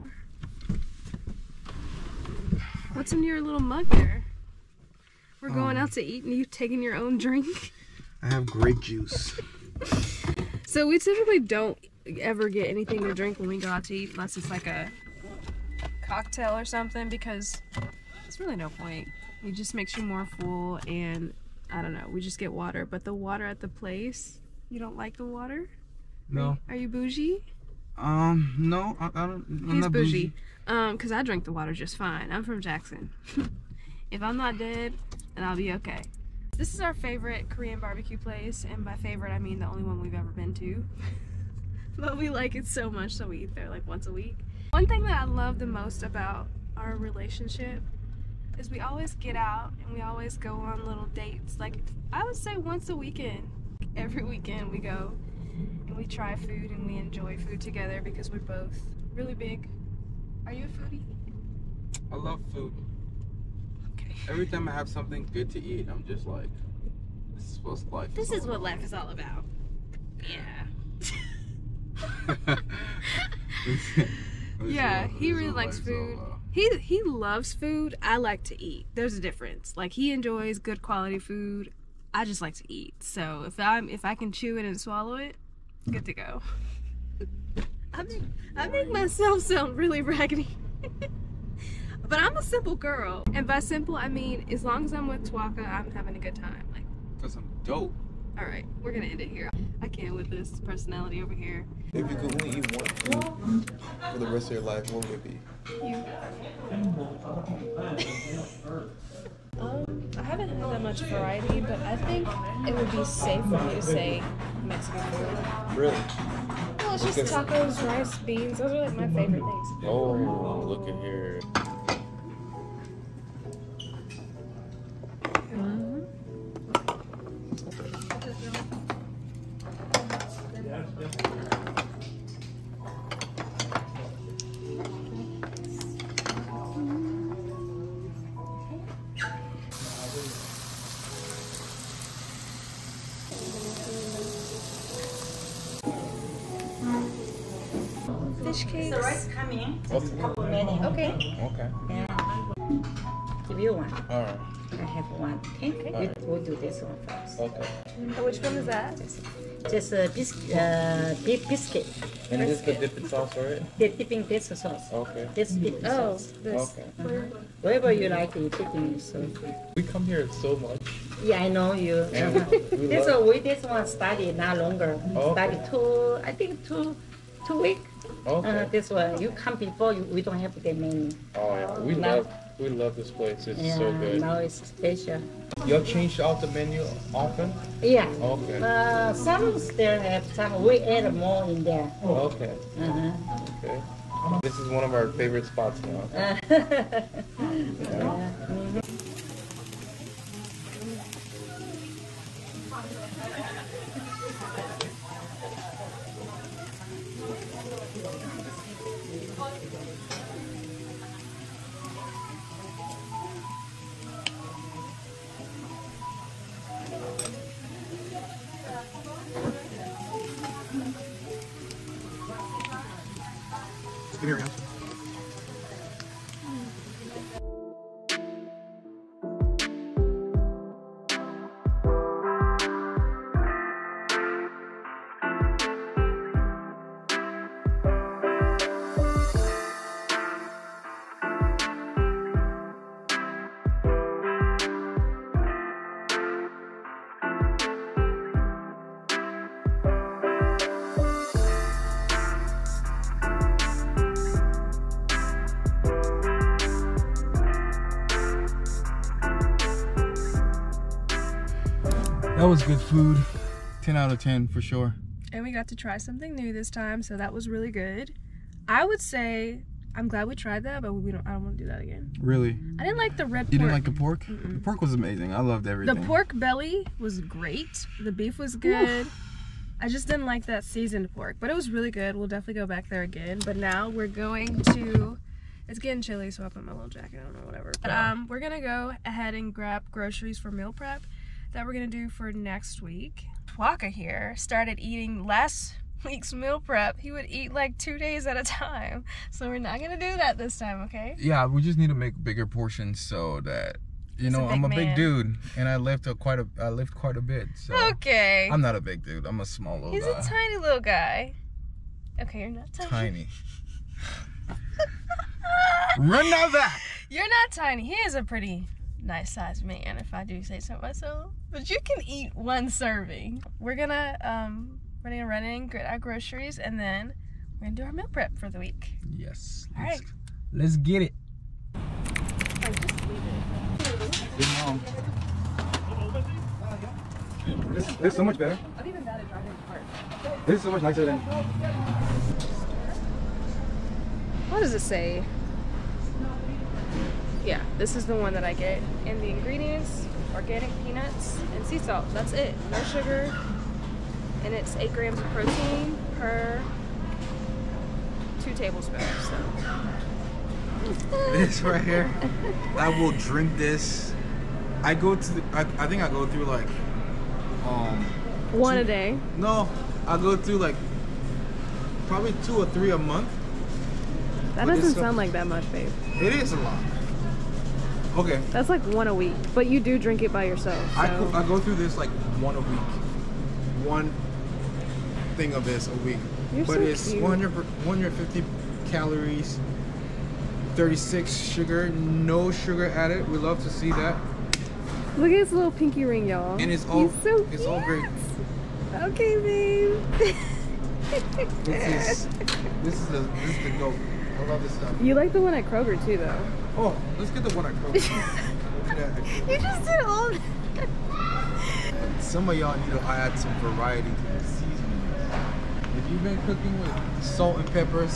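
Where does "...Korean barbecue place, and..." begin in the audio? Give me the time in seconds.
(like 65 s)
37 s.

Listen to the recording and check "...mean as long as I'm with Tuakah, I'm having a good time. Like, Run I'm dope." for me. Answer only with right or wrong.
wrong.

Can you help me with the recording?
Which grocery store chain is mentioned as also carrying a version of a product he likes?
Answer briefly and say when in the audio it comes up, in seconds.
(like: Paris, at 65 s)
Kroger, at 405 s.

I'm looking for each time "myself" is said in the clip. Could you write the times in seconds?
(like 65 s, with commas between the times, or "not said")
88 s, 320 s.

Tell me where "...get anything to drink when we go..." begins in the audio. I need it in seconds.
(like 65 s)
12 s.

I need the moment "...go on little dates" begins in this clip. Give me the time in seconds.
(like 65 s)
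50 s.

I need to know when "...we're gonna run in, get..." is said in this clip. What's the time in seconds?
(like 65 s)
325 s.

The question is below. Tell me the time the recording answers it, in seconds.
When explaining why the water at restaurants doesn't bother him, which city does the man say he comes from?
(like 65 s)
32 s.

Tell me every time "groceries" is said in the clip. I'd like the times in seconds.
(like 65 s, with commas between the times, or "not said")
289 s, 325 s.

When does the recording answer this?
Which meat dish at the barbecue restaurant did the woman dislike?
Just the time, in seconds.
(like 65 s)
280 s.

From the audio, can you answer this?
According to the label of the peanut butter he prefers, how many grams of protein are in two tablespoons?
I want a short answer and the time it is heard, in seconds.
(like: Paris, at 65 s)
8 grams, at 354 s.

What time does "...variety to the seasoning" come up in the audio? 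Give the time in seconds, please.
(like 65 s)
413 s.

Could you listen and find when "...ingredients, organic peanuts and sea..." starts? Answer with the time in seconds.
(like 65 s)
349 s.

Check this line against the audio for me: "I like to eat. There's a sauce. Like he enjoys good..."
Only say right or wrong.
wrong.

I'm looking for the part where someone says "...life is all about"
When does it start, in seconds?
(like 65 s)
68 s.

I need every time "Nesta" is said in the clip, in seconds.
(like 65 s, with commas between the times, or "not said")
not said.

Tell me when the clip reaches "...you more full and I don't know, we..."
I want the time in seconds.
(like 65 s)
19 s.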